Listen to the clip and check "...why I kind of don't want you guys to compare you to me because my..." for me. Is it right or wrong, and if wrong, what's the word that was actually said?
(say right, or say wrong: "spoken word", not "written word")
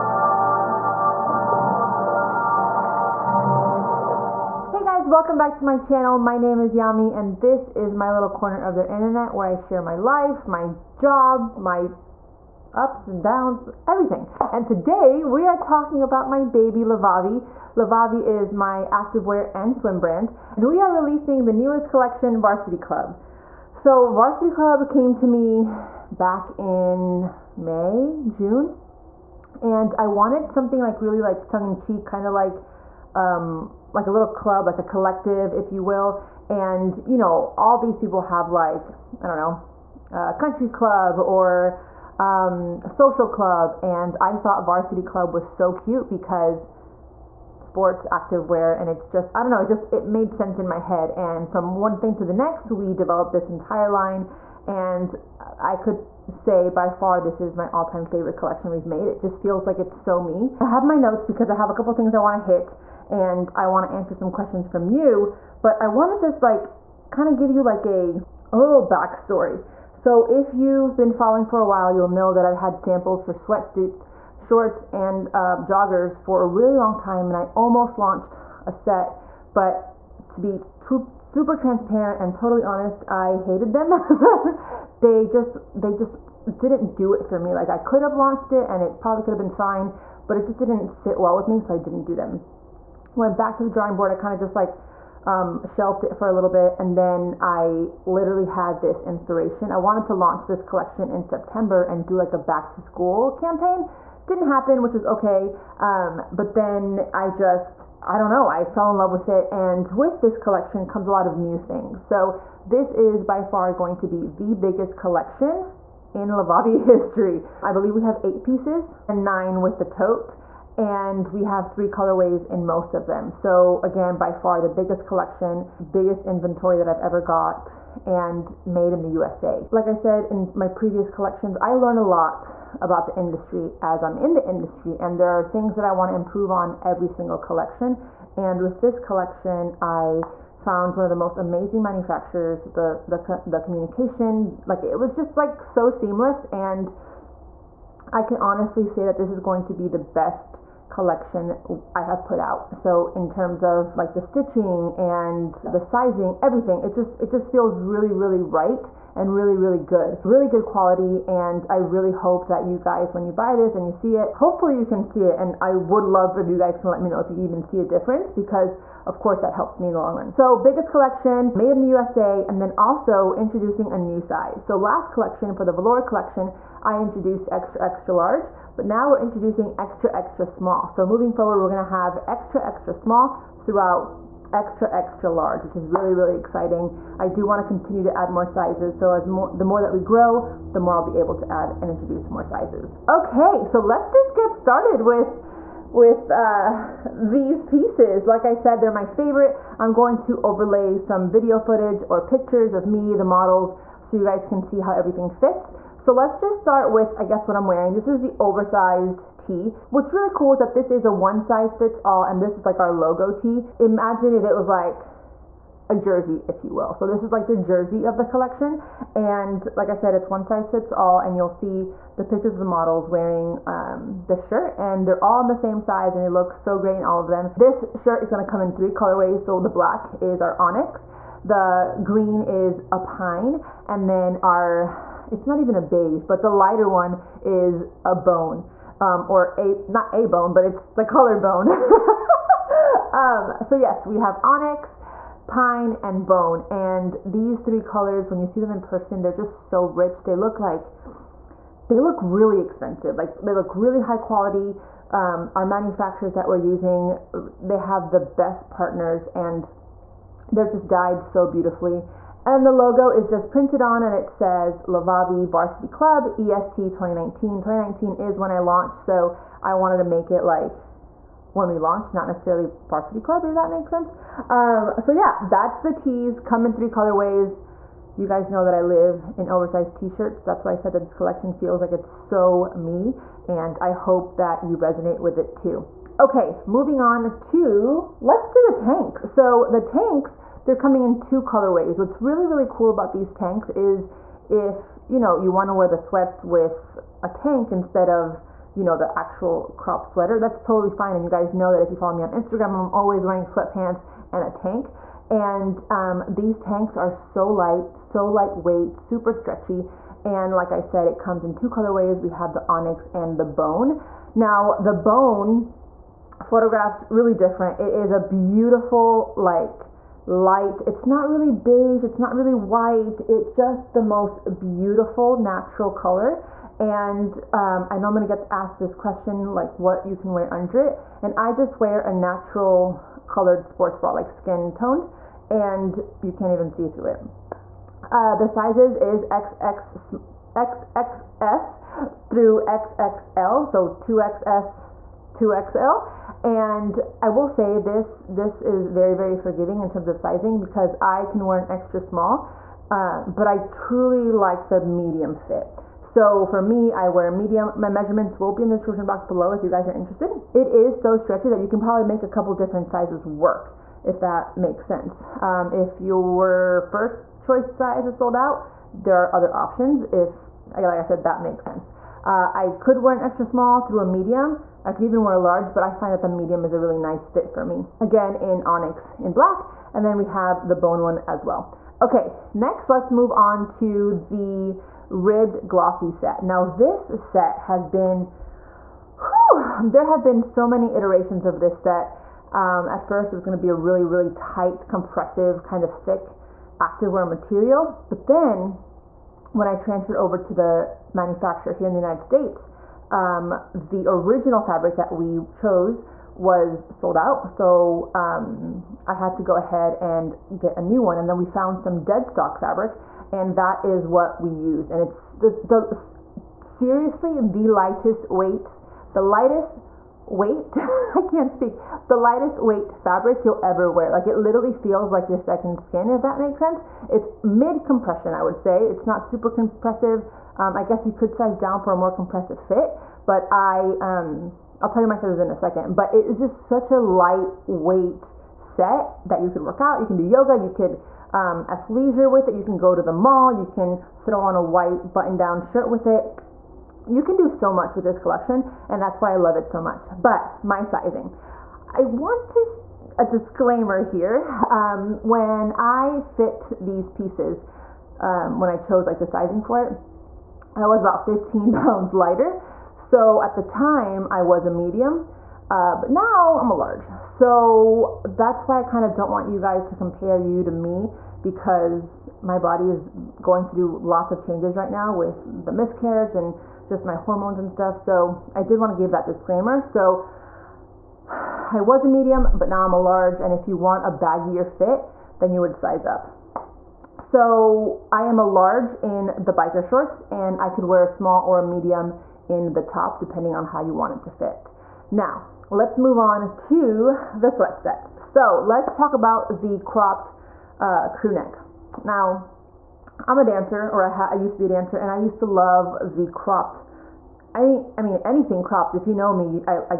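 right.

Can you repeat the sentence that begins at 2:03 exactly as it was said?
So again, by far the biggest collection, biggest inventory that I've ever got and made in the USA.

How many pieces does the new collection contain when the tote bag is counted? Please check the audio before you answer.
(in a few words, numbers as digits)
9.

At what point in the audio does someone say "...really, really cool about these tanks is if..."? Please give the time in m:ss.
4:52.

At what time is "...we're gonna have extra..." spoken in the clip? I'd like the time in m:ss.
3:01.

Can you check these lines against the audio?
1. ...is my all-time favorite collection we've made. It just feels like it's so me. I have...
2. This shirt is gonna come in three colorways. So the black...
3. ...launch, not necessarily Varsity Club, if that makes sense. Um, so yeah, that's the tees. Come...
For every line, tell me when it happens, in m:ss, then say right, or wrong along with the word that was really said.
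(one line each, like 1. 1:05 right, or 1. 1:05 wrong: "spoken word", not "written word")
1. 0:57 right
2. 3:47 right
3. 4:31 right.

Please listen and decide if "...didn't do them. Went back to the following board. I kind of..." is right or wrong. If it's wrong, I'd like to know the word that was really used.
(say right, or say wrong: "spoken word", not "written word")
wrong: "drawing", not "following".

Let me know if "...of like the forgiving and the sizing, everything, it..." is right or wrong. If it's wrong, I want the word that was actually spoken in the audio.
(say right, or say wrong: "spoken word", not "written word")
wrong: "stitching", not "forgiving".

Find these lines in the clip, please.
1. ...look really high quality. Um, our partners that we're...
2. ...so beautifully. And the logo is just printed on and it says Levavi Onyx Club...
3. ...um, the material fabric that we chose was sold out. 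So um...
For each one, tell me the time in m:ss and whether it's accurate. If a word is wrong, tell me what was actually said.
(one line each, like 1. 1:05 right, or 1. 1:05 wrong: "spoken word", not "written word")
1. 4:13 wrong: "manufacturers", not "partners"
2. 4:21 wrong: "Varsity", not "Onyx"
3. 6:43 wrong: "original", not "material".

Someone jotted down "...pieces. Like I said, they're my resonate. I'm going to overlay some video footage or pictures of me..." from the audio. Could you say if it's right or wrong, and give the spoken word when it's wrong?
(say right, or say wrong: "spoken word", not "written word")
wrong: "favorite", not "resonate".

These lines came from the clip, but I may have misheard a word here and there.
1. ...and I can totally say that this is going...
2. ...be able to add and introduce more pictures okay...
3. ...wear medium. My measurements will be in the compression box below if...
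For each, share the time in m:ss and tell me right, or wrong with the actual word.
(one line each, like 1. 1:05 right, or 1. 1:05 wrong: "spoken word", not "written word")
1. 2:26 wrong: "honestly", not "totally"
2. 3:11 wrong: "sizes", not "pictures"
3. 5:57 wrong: "description", not "compression".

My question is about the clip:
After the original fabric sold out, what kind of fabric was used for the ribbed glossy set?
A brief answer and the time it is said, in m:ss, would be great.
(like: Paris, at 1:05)
Dead stock fabric, at 6:52.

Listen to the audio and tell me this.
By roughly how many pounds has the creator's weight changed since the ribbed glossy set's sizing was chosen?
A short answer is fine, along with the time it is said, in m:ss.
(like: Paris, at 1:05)
15, at 7:41.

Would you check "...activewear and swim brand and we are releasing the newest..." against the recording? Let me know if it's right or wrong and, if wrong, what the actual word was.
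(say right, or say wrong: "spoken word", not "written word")
right.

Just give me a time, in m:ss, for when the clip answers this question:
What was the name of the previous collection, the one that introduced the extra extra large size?
2:55.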